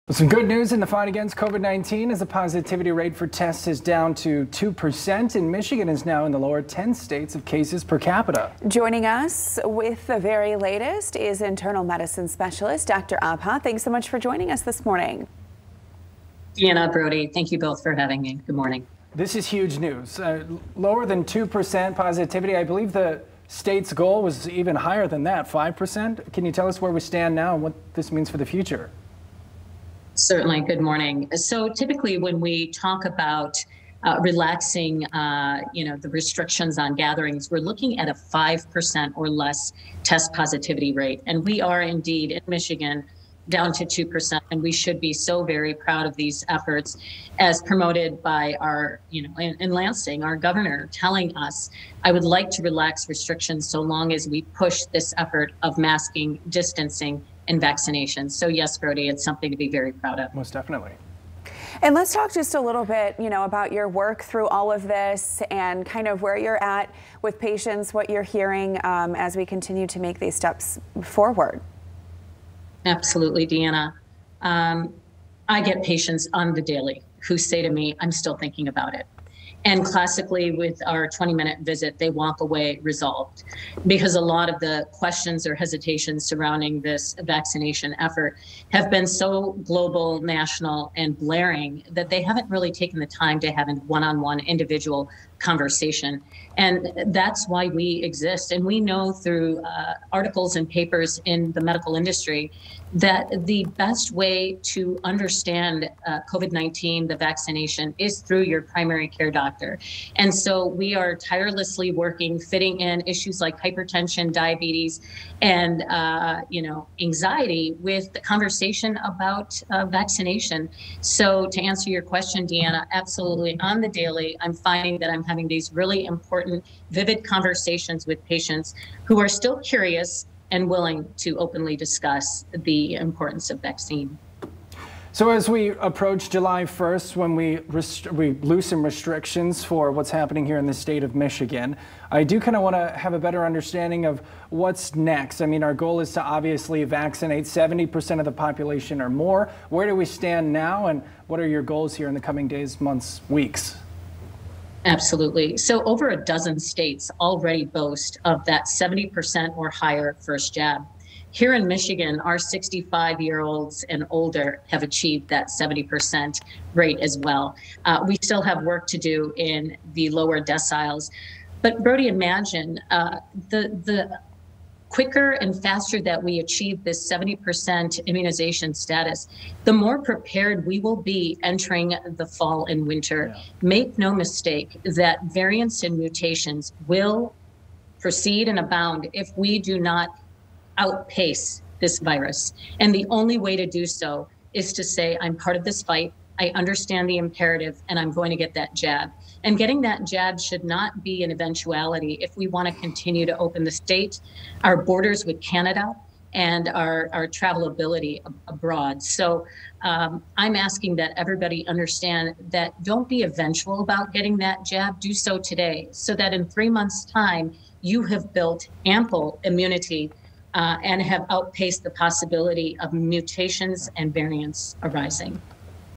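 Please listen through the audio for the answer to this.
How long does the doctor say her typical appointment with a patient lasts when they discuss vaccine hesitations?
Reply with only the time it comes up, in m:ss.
1:21.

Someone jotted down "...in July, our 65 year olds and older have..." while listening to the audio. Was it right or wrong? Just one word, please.
wrong.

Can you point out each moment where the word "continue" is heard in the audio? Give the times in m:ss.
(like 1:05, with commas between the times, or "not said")
1:09, 3:22.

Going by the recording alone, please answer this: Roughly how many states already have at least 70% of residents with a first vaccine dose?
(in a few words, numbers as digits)
Over a dozen.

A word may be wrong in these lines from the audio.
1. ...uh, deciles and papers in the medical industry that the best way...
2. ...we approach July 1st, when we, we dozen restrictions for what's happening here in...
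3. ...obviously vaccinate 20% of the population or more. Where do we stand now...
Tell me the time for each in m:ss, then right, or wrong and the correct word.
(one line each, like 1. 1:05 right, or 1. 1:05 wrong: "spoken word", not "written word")
1. 1:39 wrong: "articles", not "deciles"
2. 2:15 wrong: "loosen", not "dozen"
3. 2:26 wrong: "70", not "20".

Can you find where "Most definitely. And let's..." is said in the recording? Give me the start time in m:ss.
1:00.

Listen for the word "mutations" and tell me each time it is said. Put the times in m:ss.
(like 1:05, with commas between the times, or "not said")
3:05, 3:42.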